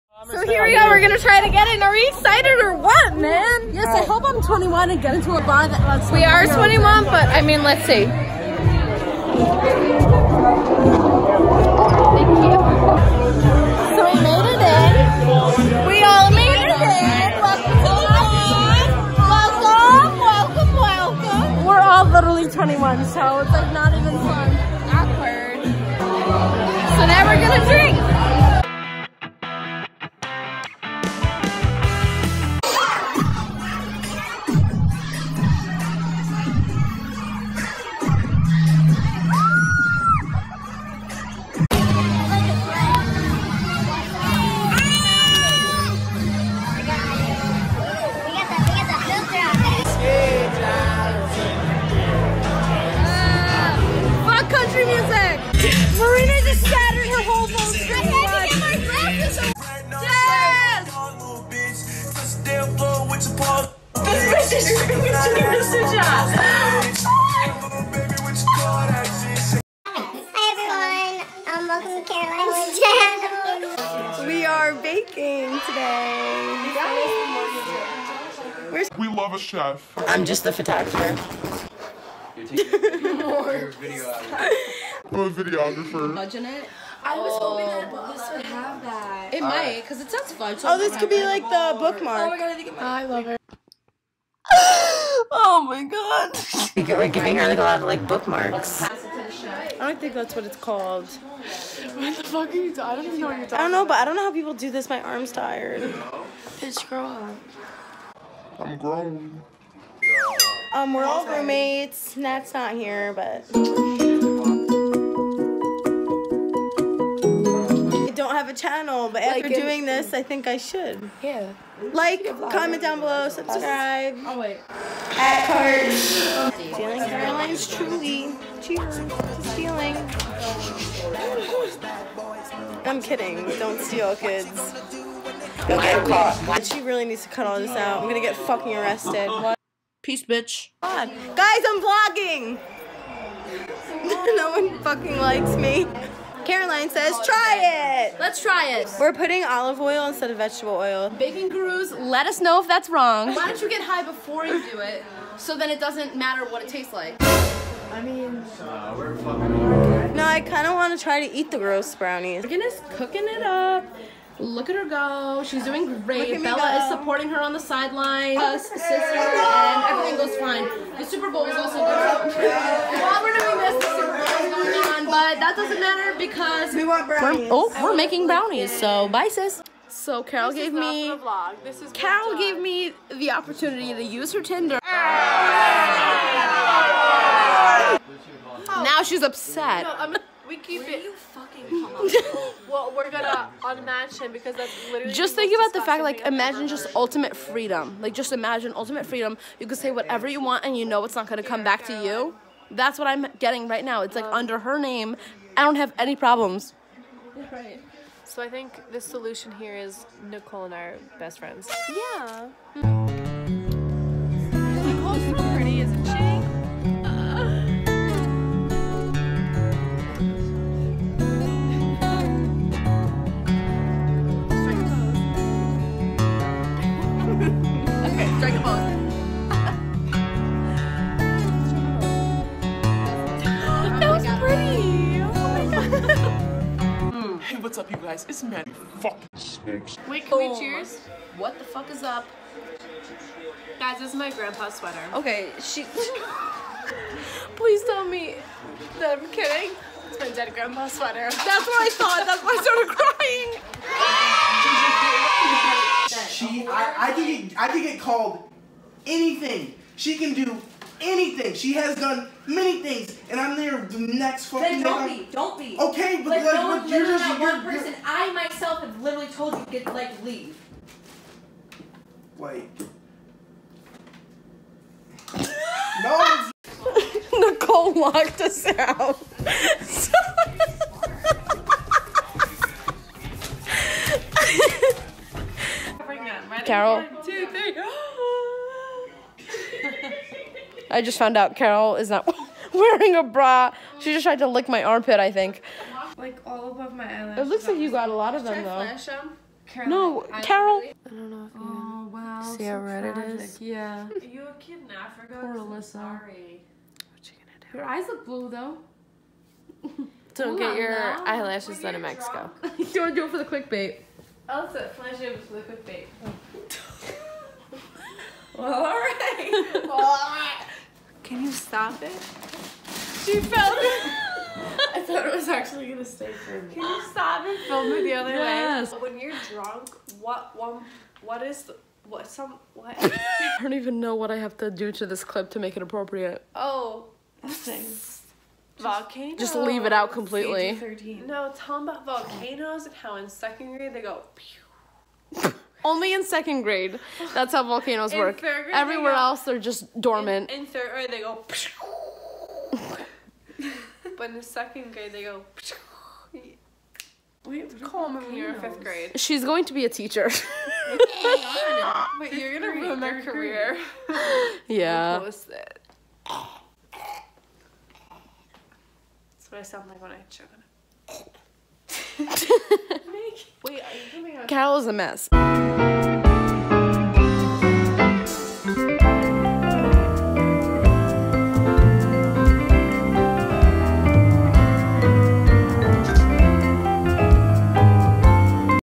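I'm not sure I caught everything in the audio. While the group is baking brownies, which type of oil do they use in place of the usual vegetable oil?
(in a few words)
olive oil.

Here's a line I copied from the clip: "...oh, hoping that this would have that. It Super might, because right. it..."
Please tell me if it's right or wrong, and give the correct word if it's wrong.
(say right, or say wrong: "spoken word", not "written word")
wrong: "All", not "Super".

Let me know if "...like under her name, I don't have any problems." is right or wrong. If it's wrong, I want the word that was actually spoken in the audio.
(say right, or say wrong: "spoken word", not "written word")
right.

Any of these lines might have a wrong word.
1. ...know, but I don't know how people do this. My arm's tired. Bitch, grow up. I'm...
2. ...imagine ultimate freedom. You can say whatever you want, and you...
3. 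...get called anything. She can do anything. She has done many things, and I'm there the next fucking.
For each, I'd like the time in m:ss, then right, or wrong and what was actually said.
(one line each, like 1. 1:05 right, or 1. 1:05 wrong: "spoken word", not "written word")
1. 1:43 right
2. 3:18 right
3. 4:17 right.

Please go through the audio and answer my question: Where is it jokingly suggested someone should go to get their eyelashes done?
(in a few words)
Mexico.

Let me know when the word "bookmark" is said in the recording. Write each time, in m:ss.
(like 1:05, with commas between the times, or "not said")
1:31, 1:38.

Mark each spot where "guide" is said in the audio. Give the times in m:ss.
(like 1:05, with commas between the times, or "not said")
not said.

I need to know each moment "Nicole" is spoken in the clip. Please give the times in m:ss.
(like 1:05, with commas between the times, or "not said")
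3:30, 4:37.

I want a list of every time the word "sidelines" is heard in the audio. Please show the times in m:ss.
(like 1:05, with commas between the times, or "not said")
2:47.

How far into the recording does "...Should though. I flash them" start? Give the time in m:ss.
4:58.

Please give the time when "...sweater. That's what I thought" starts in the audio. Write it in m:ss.
4:10.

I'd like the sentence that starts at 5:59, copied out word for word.
She's going to be a teacher.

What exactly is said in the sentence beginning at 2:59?
So Carol this gave me Carol gave me the opportunity to use her Tinder.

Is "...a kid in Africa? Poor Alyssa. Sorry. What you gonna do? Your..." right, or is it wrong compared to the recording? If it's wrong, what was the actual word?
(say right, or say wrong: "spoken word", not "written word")
right.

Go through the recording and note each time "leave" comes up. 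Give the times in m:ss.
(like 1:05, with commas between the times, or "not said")
4:30, 5:39.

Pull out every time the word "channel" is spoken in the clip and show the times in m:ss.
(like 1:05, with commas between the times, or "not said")
1:12, 1:58.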